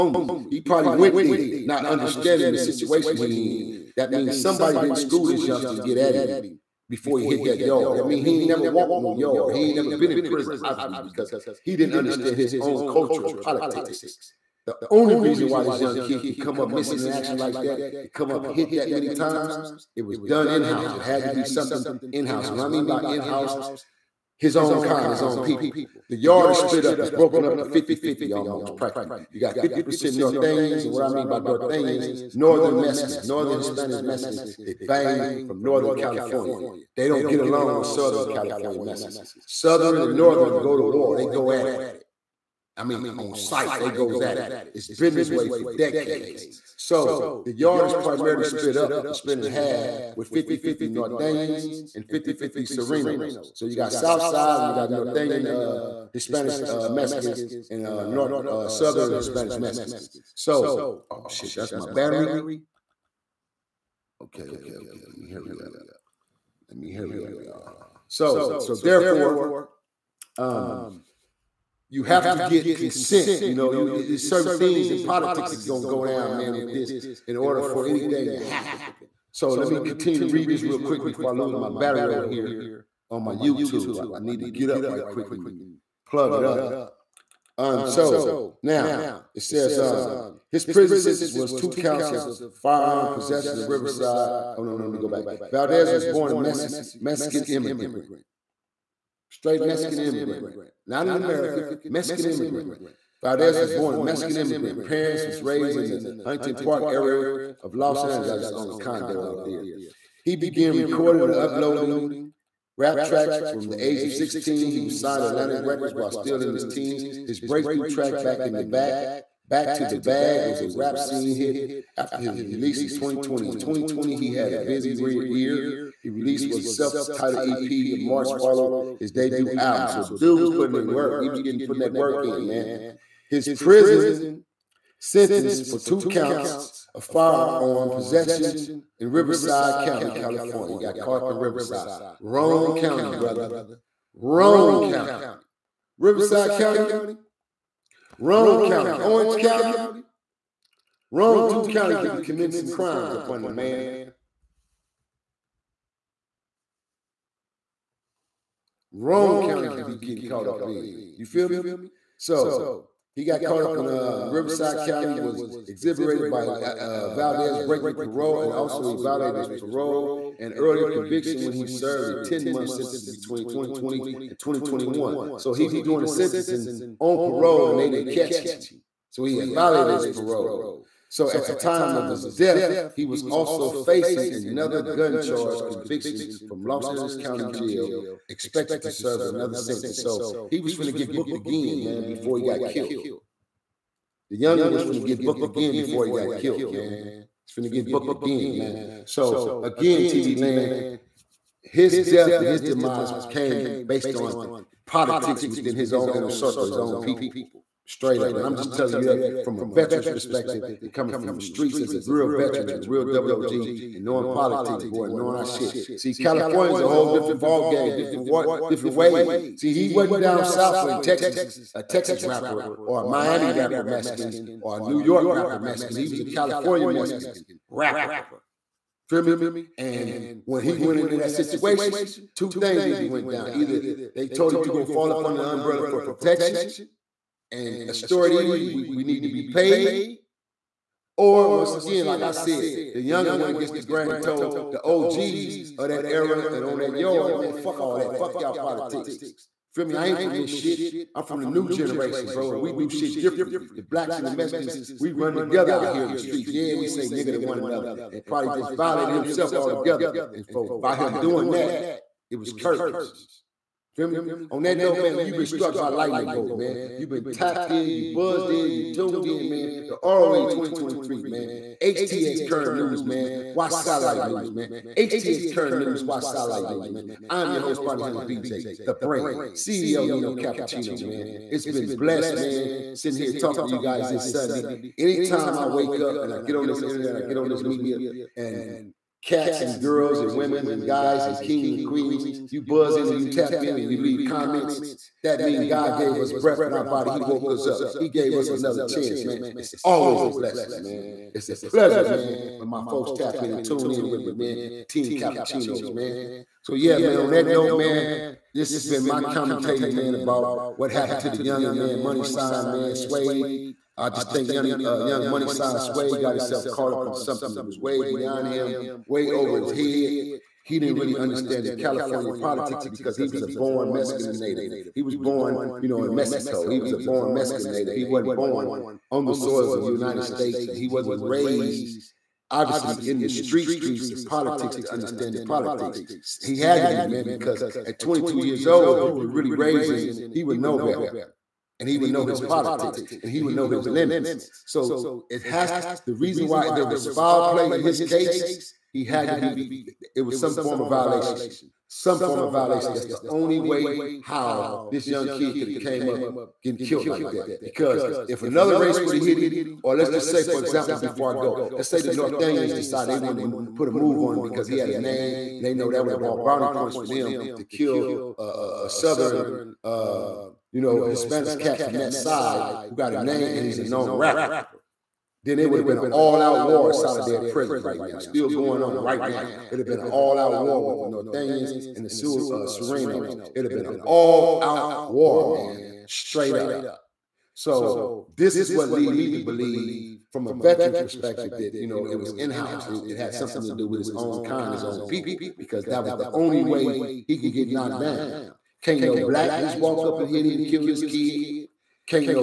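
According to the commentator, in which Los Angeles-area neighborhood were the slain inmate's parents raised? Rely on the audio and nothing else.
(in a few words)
Huntington Park.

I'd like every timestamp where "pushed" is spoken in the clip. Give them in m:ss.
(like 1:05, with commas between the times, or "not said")
not said.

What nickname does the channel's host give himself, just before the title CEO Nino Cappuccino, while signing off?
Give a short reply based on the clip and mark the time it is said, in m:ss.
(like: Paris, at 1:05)
Bounty Hunter BJ, at 4:37.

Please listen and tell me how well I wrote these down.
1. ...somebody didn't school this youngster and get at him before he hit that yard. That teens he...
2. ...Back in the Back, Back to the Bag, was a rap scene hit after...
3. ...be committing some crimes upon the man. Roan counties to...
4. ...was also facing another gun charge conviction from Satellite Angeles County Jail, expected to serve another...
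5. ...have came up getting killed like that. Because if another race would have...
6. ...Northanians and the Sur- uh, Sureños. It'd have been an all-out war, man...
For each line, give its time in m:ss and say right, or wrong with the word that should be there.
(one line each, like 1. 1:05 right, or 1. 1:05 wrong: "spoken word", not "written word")
1. 0:04 wrong: "means", not "teens"
2. 1:58 right
3. 2:32 right
4. 3:03 wrong: "Los", not "Satellite"
5. 5:55 right
6. 6:21 right.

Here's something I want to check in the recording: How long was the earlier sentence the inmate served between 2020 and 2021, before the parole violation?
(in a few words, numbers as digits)
10 months.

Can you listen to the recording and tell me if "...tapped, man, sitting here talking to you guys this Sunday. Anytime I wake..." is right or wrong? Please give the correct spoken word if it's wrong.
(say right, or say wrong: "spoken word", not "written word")
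wrong: "blessed", not "tapped".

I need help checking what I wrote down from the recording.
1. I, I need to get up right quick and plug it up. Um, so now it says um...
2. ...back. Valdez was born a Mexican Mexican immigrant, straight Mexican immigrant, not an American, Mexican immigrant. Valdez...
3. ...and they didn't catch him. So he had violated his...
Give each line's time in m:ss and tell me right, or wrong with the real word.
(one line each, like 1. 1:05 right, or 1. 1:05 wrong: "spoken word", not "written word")
1. 1:24 right
2. 1:35 right
3. 2:57 right.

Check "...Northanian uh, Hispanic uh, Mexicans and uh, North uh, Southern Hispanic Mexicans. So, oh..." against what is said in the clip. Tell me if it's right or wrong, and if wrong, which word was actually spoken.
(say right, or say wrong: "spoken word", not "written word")
right.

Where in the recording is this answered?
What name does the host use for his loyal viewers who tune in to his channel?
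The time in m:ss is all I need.
5:04.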